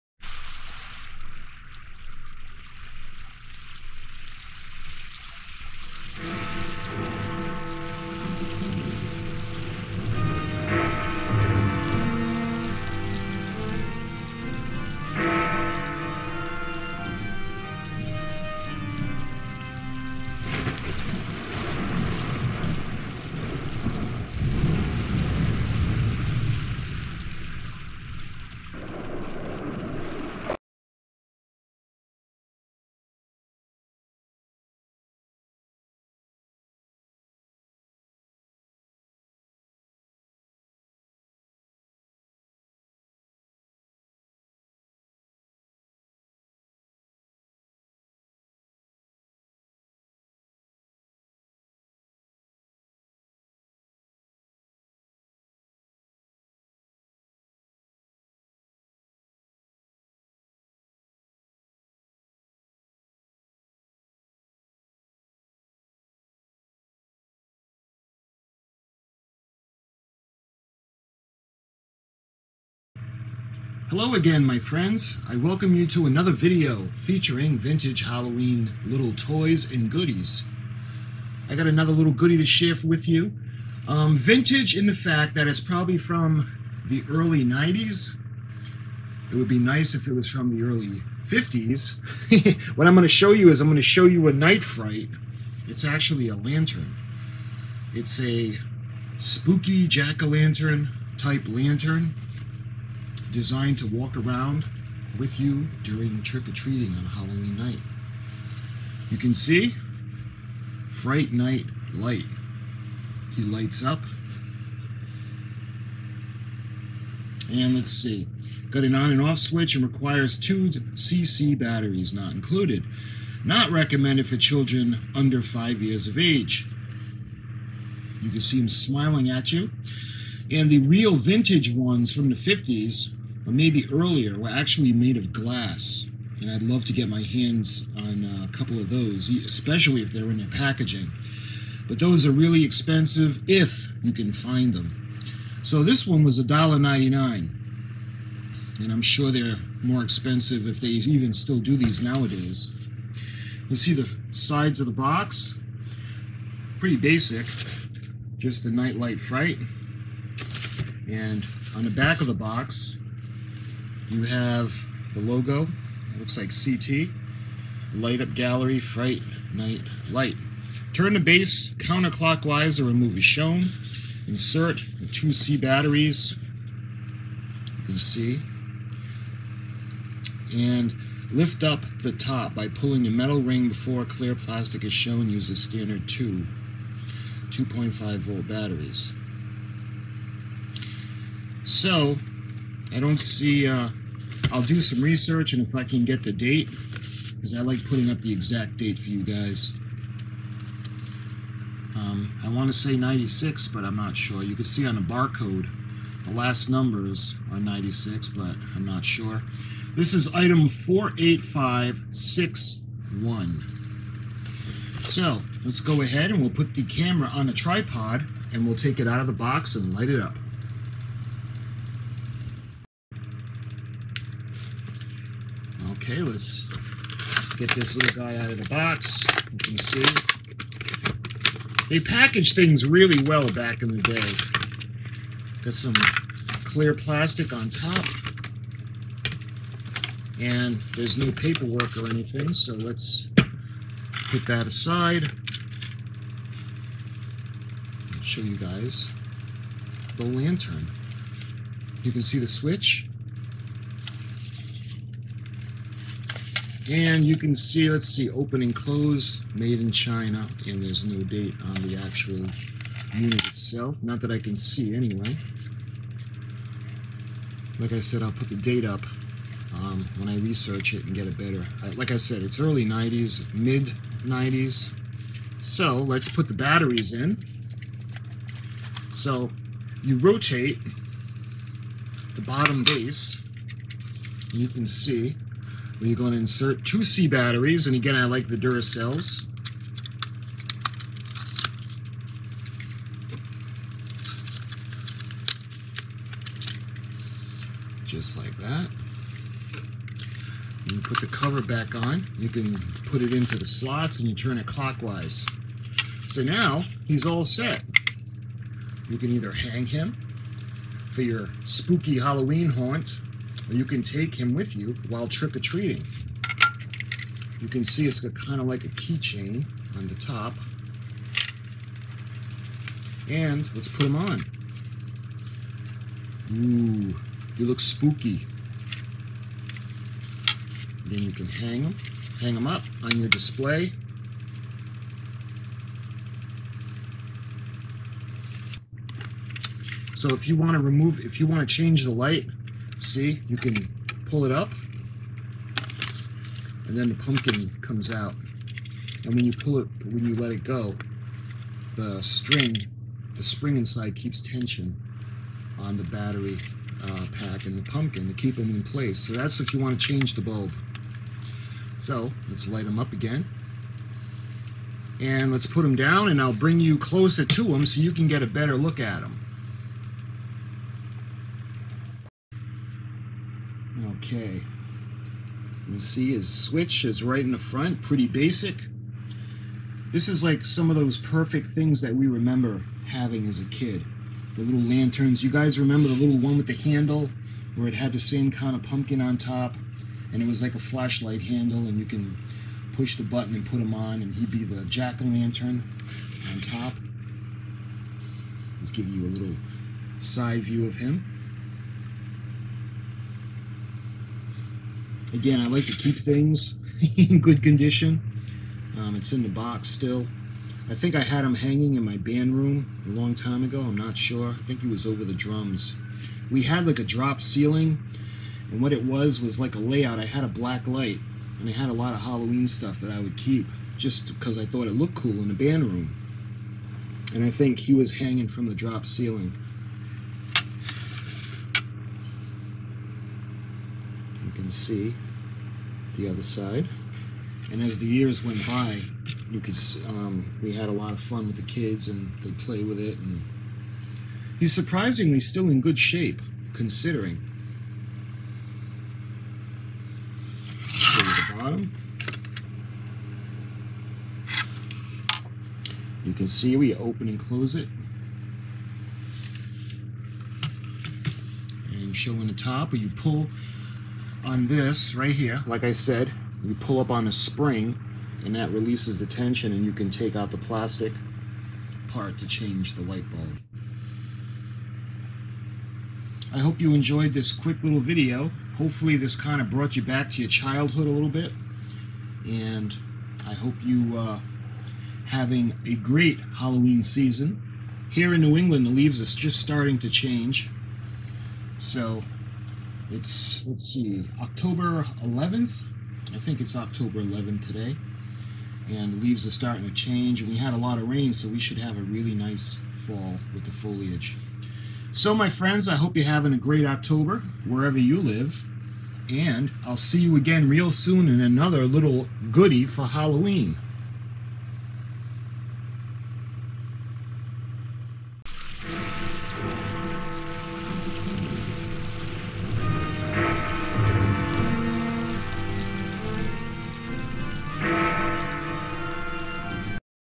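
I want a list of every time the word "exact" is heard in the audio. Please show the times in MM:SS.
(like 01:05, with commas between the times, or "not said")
03:18.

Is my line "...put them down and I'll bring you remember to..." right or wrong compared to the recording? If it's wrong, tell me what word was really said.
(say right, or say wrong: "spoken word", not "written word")
wrong: "closer", not "remember".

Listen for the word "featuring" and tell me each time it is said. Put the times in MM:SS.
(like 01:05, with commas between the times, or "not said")
01:16.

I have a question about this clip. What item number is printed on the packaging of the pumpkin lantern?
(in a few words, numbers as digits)
48561.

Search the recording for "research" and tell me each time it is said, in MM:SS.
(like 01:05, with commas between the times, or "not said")
03:15, 04:30.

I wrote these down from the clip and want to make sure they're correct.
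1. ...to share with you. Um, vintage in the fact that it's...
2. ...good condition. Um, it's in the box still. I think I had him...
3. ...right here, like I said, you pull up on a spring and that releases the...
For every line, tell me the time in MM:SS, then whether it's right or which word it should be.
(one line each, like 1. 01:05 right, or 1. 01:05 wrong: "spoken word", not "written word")
1. 01:22 right
2. 06:47 right
3. 07:45 right.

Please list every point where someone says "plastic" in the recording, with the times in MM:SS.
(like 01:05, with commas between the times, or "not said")
03:04, 03:56, 07:50.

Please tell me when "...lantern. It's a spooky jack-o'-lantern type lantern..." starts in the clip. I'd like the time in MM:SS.
01:36.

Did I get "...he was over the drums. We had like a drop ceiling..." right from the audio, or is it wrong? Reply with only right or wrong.
right.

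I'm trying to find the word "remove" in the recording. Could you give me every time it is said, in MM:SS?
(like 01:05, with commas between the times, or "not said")
02:52, 05:40.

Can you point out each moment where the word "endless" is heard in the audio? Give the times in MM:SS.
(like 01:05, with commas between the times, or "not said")
not said.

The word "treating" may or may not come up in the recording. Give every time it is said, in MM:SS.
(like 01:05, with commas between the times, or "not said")
01:46, 05:15.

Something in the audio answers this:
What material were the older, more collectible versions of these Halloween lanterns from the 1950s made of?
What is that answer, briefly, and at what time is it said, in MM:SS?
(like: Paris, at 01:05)
Glass, at 02:15.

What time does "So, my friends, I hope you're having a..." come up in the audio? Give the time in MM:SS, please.
08:25.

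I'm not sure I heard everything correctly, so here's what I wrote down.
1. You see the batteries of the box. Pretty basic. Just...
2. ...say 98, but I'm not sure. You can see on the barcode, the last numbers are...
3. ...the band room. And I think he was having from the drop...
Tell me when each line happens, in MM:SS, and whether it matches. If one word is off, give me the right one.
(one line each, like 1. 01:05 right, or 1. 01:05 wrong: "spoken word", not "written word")
1. 02:33 wrong: "sides", not "batteries"
2. 03:22 wrong: "96", not "98"
3. 07:05 wrong: "hanging", not "having".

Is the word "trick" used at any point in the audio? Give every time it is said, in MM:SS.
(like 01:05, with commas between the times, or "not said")
01:46, 05:15.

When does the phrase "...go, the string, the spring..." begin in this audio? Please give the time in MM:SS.
05:50.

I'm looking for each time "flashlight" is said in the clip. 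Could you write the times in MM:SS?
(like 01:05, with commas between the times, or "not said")
06:30.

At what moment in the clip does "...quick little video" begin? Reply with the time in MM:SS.
07:57.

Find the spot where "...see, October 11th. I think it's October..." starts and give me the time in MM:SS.
08:13.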